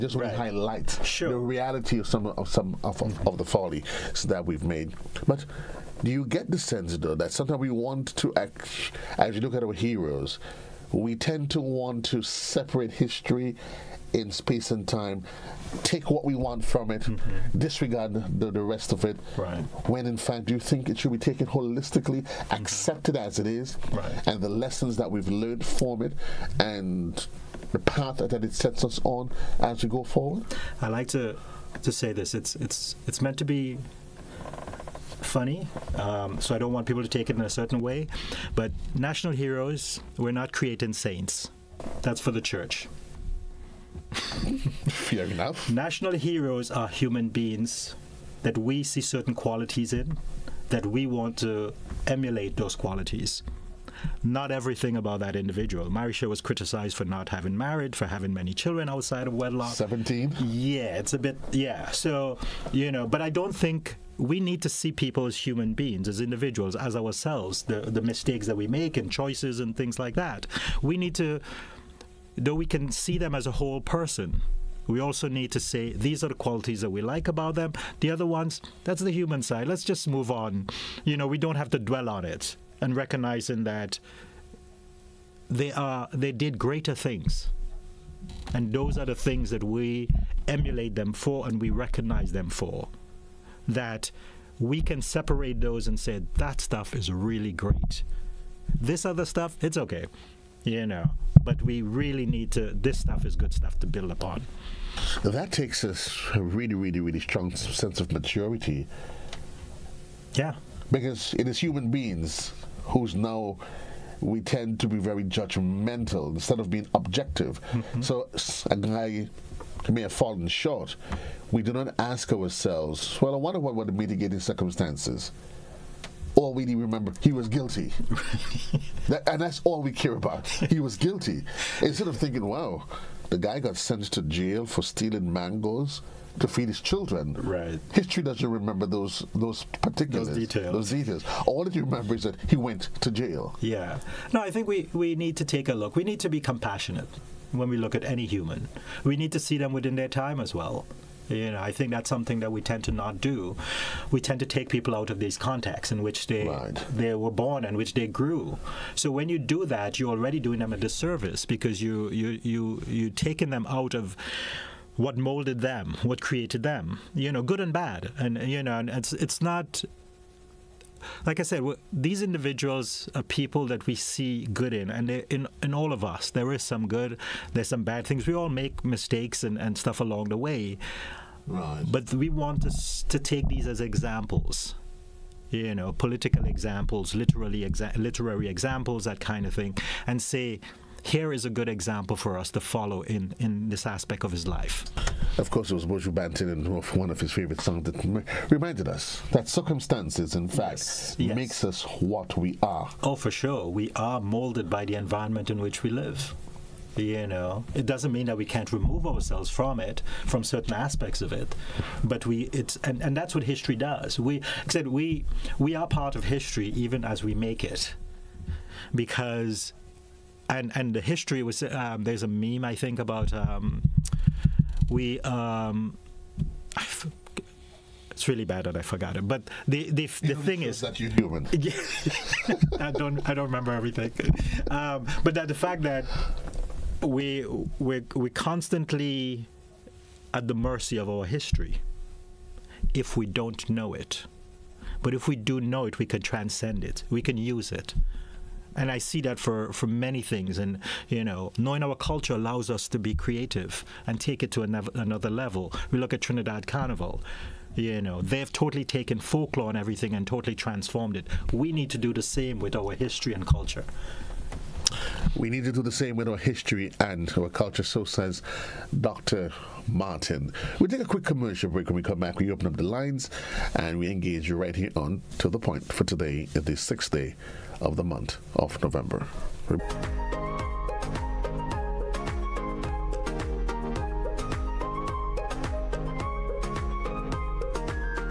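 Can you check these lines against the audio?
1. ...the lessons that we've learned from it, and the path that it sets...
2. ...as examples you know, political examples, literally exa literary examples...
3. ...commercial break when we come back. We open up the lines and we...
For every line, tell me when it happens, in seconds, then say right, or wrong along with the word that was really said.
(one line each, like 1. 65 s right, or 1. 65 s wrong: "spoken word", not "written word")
1. 24 s right
2. 183 s right
3. 271 s right.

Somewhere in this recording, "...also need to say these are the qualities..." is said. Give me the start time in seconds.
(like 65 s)
74 s.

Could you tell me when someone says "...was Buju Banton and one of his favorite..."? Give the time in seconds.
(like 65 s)
195 s.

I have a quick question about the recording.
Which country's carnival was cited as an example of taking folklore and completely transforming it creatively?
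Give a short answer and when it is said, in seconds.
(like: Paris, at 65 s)
Trinidad, at 256 s.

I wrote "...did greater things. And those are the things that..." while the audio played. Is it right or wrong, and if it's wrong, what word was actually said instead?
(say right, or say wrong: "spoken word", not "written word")
right.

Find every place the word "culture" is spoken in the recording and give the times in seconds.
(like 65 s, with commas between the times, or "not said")
251 s, 263 s, 267 s.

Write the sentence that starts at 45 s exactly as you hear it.
National heroes are human beings that we see certain qualities in, that we want to emulate those qualities.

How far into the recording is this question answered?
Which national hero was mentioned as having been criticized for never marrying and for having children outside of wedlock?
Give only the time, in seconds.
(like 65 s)
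55 s.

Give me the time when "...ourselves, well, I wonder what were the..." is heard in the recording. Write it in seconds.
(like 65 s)
122 s.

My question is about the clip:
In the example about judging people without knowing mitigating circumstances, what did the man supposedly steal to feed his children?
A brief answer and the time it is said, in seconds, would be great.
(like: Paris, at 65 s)
Mangoes, at 135 s.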